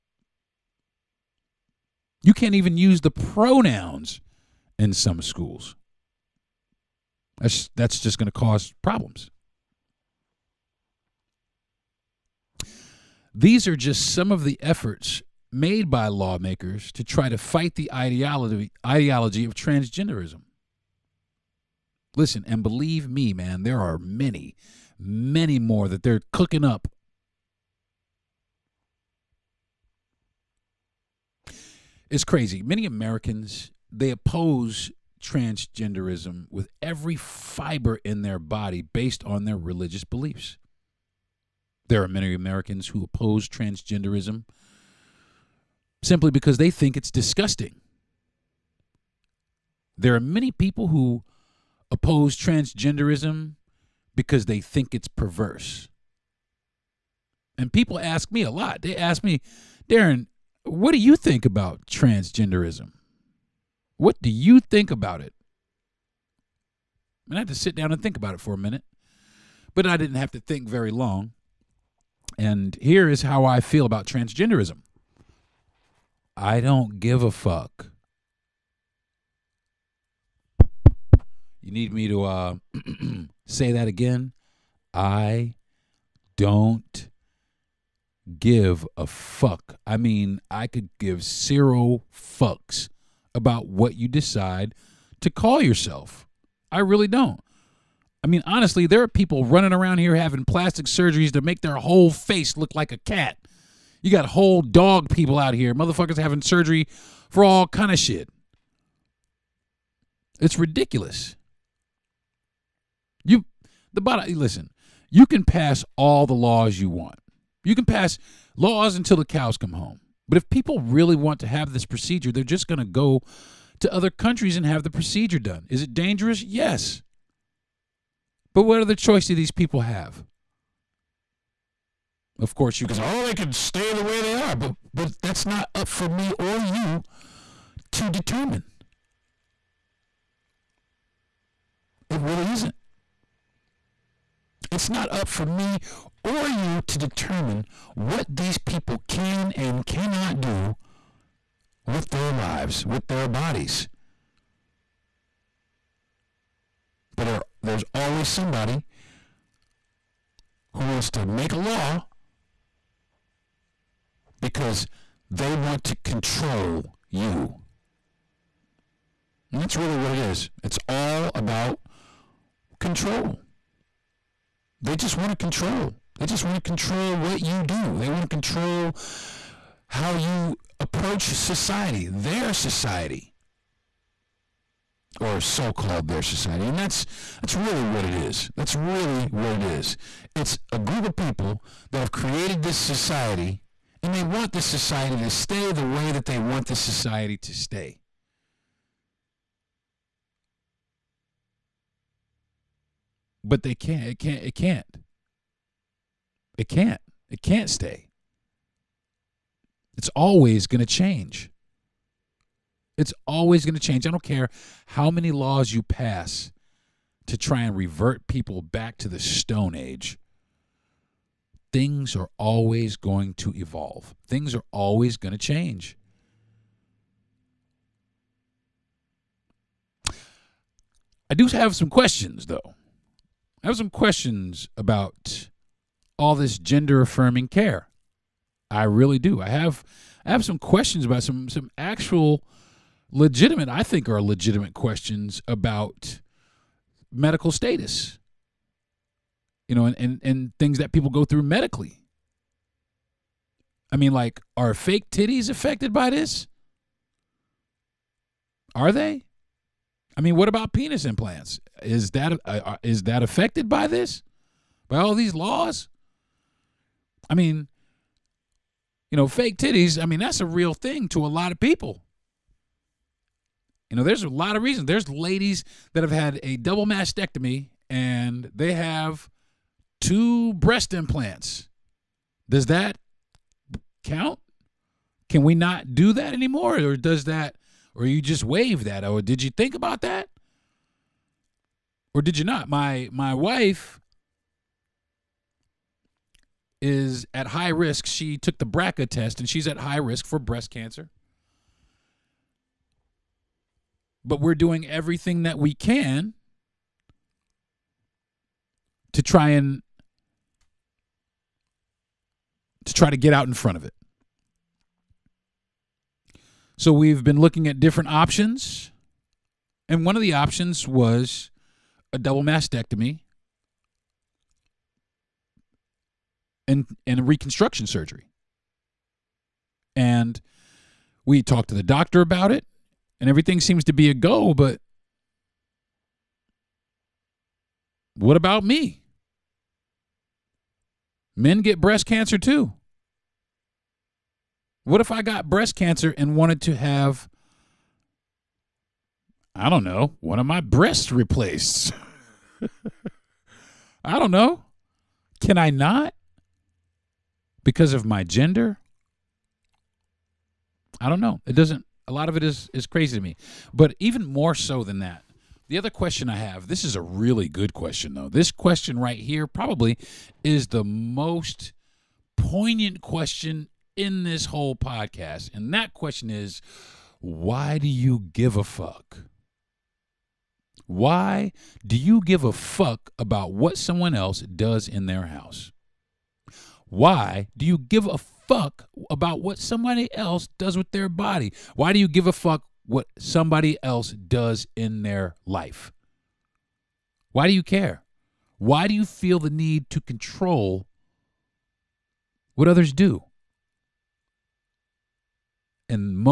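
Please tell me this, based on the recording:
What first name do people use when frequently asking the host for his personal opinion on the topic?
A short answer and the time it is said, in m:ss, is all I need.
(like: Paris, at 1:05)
Deron, at 0:59.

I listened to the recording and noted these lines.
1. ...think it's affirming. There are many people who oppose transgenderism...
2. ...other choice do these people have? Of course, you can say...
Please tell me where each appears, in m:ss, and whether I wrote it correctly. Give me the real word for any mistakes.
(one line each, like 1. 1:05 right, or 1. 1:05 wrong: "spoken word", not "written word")
1. 0:46 wrong: "disgusting", not "affirming"
2. 2:08 right.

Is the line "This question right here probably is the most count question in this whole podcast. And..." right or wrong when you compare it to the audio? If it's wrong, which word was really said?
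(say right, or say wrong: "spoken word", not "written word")
wrong: "poignant", not "count".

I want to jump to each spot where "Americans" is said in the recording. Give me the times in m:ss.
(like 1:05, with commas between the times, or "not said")
0:32, 0:42.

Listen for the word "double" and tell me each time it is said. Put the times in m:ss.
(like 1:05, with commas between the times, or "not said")
4:36, 5:22.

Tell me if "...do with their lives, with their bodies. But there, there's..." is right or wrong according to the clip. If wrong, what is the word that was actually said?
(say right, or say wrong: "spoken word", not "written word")
right.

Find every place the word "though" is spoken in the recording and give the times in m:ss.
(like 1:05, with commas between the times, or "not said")
3:52, 6:08.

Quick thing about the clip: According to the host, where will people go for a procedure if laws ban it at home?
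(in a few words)
other countries.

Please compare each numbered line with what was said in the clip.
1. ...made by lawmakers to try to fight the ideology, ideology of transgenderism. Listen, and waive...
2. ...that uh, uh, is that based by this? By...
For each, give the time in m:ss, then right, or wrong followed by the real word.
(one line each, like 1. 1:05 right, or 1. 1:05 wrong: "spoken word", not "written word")
1. 0:15 wrong: "believe", not "waive"
2. 4:22 wrong: "affected", not "based".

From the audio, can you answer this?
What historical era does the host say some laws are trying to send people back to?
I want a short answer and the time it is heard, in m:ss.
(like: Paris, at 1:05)
the Stone Age, at 3:39.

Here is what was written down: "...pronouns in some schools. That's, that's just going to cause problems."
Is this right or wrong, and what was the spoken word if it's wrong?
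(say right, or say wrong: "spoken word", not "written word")
right.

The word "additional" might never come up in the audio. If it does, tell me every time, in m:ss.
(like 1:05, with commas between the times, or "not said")
not said.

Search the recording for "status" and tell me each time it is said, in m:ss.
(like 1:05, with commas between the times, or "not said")
4:07.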